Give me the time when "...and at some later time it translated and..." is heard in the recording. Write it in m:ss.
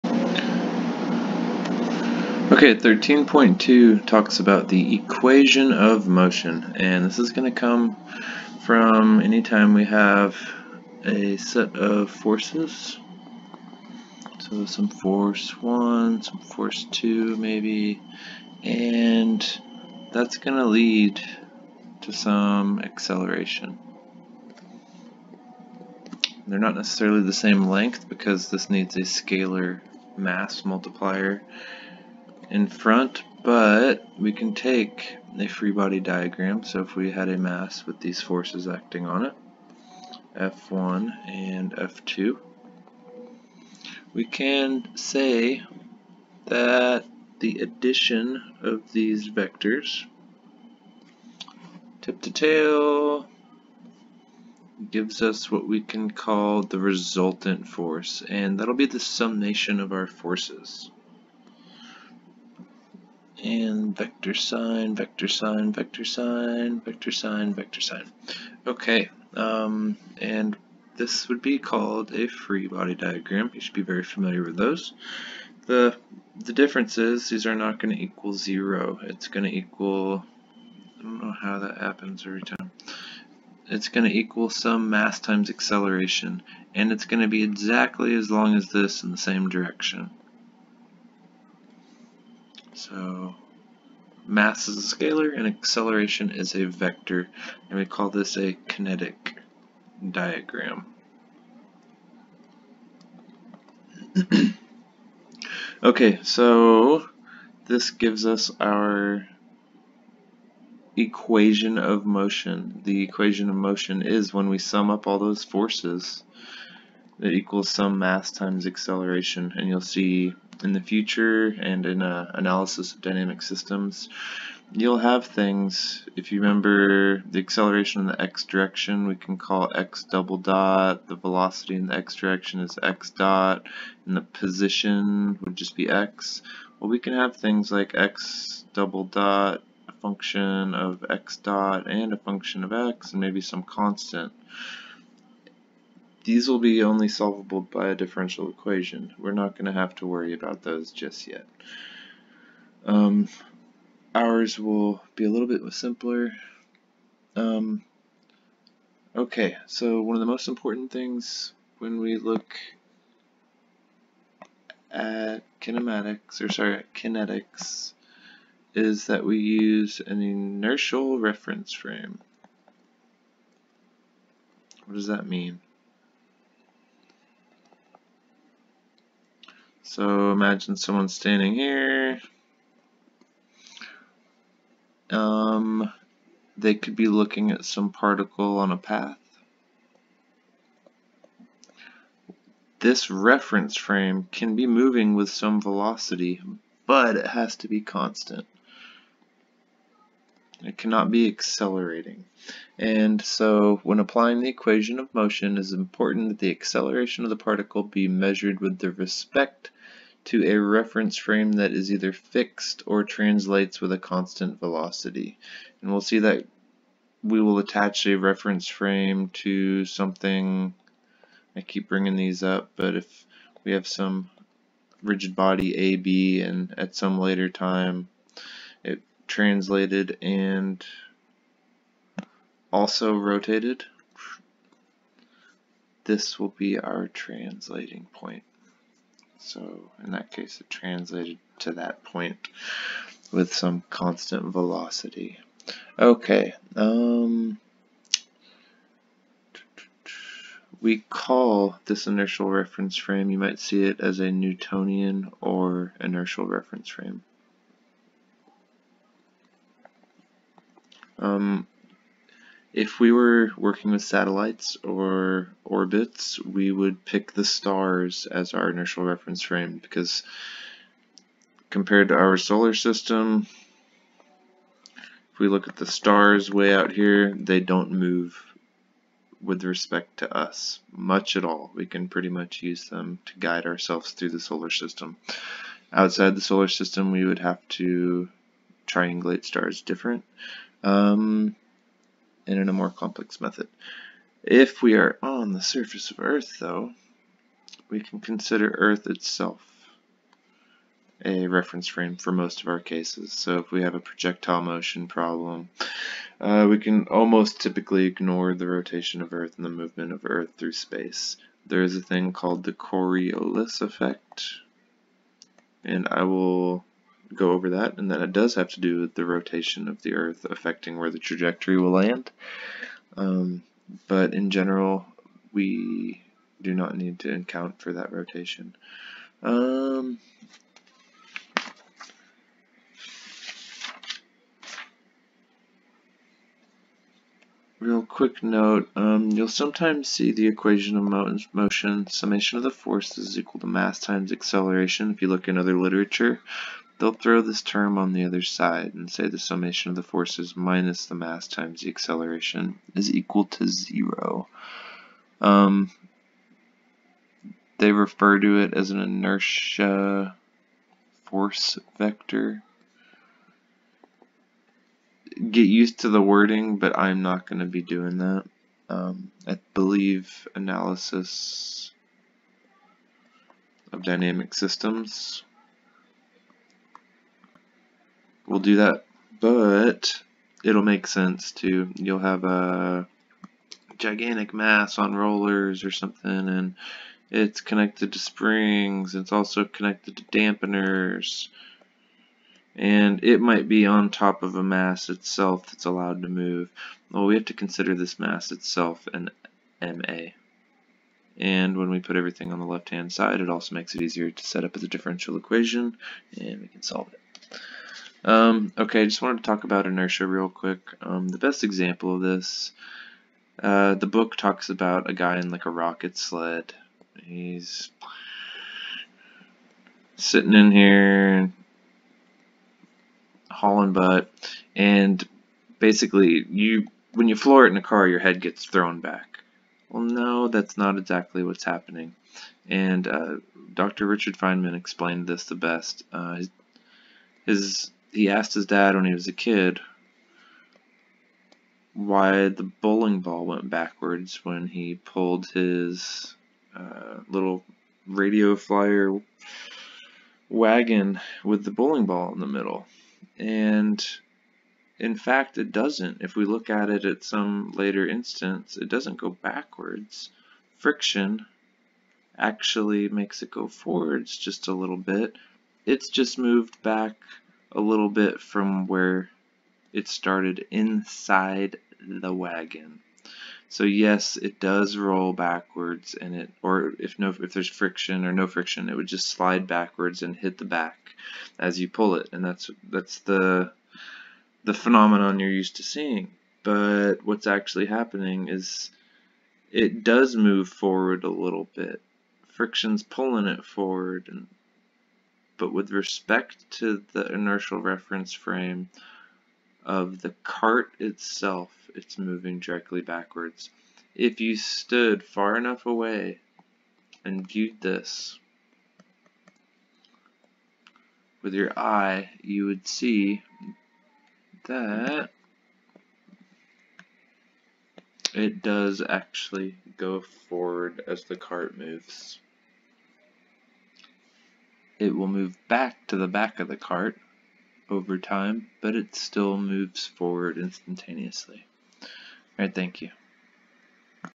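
3:46.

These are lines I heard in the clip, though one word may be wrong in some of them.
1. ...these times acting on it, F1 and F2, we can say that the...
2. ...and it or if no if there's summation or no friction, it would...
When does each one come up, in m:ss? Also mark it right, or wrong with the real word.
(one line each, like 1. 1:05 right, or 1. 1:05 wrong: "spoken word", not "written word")
1. 0:38 wrong: "forces", not "times"
2. 7:56 wrong: "friction", not "summation".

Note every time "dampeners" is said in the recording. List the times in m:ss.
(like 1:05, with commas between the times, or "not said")
6:30.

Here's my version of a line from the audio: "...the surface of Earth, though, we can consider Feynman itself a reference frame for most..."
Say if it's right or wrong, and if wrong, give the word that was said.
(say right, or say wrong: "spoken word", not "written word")
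wrong: "Earth", not "Feynman".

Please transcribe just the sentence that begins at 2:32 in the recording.
Um, ours will be a little bit simpler.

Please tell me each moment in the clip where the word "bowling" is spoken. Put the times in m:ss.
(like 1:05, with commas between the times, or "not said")
7:22, 7:31.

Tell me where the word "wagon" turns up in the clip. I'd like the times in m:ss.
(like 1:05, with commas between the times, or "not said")
7:30, 7:52.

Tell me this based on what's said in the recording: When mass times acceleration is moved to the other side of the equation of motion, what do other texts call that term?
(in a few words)
inertia force vector.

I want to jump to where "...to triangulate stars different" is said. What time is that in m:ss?
4:47.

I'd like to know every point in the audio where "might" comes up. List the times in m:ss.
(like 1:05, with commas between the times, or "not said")
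4:13, 6:33.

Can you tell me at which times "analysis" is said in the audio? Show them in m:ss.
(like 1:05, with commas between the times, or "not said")
2:02, 6:10.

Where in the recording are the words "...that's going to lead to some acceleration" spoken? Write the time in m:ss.
0:20.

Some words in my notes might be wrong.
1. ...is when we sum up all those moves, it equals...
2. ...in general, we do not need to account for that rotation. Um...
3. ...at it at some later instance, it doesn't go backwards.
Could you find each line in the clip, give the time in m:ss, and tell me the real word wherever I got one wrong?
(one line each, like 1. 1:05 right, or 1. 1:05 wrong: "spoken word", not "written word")
1. 1:54 wrong: "forces", not "moves"
2. 5:24 right
3. 7:36 right.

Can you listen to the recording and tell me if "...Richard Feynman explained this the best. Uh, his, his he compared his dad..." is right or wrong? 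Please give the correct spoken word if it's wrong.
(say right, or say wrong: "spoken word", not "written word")
wrong: "asked", not "compared".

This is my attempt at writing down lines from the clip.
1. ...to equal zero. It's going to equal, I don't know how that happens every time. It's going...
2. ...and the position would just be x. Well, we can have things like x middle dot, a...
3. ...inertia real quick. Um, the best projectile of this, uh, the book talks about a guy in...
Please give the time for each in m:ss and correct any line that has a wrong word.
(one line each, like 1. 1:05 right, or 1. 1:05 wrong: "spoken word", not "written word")
1. 1:17 right
2. 2:14 wrong: "double", not "middle"
3. 6:49 wrong: "example", not "projectile".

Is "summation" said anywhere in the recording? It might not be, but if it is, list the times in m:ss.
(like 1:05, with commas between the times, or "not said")
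0:58, 5:42, 5:49.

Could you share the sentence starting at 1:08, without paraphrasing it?
Okay, um, and this would be called a free body diagram.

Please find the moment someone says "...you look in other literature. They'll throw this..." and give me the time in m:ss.
5:45.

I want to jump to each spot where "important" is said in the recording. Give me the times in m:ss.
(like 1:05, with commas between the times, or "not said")
2:40, 3:25.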